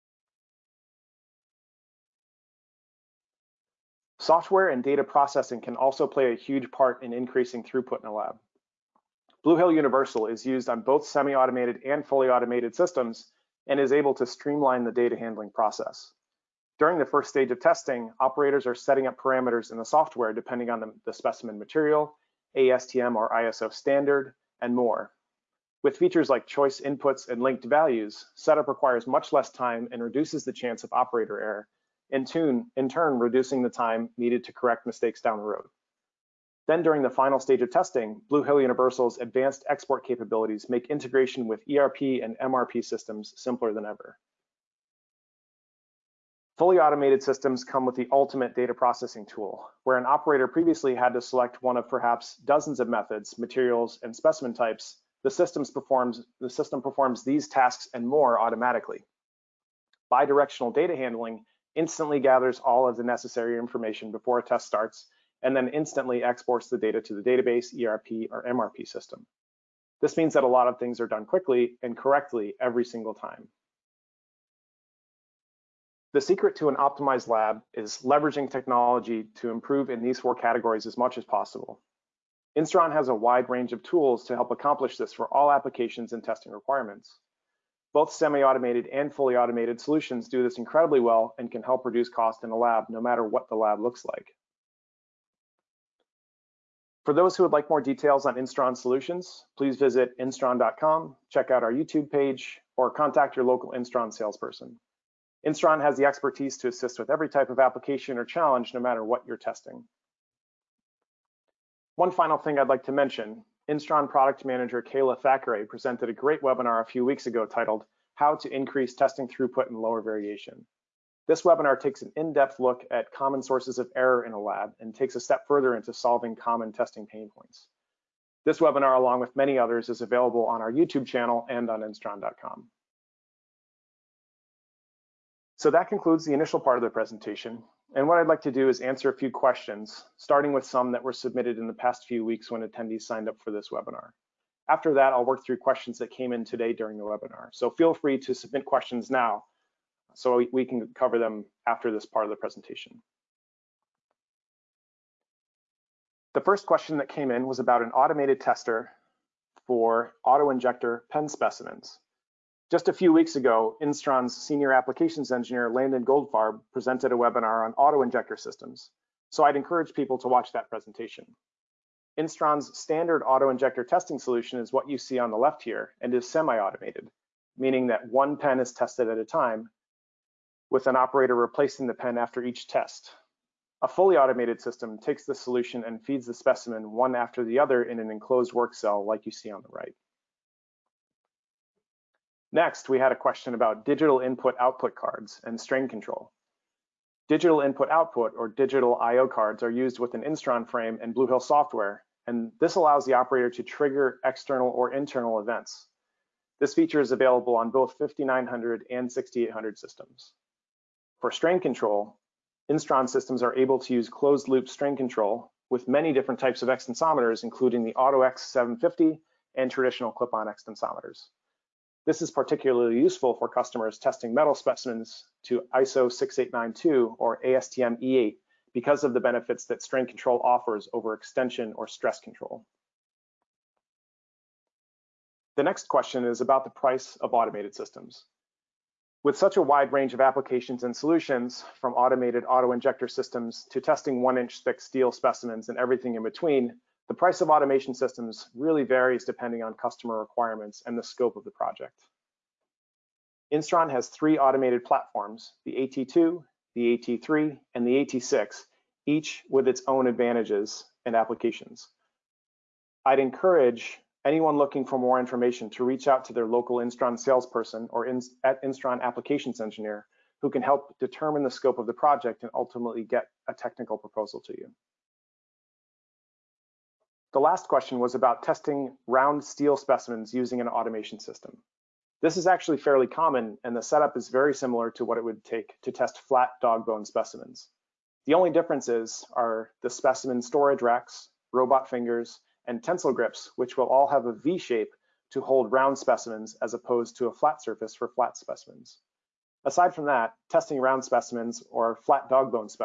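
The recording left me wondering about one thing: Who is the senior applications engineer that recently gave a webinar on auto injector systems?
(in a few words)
Landon Goldfarb.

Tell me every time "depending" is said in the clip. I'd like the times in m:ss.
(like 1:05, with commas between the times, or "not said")
0:20, 4:09.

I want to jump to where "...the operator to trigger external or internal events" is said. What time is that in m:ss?
3:23.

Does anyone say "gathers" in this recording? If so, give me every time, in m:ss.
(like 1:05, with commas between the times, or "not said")
1:02.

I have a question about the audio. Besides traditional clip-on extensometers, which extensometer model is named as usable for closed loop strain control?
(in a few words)
AutoX 750.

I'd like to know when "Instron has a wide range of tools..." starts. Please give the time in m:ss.
1:22.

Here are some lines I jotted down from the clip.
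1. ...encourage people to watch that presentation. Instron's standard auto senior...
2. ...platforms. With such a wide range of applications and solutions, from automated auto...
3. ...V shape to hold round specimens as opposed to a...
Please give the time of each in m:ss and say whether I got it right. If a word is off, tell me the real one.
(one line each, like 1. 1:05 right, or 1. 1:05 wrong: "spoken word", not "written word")
1. 2:49 wrong: "injector", not "senior"
2. 3:57 wrong: "systems", not "platforms"
3. 4:54 right.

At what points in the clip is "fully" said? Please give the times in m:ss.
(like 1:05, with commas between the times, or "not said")
0:12, 0:46, 1:29, 3:03.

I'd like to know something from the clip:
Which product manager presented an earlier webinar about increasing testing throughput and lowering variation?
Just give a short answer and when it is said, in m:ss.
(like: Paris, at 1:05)
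Kayla Thackeray, at 1:54.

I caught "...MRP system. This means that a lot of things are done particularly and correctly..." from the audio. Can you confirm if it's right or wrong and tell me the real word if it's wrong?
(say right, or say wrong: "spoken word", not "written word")
wrong: "quickly", not "particularly".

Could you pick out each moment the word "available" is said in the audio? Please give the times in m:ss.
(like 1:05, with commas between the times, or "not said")
2:10, 3:27.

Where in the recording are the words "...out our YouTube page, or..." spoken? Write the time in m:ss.
1:41.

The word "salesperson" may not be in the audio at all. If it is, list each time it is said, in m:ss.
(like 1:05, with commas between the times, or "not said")
1:44, 4:27.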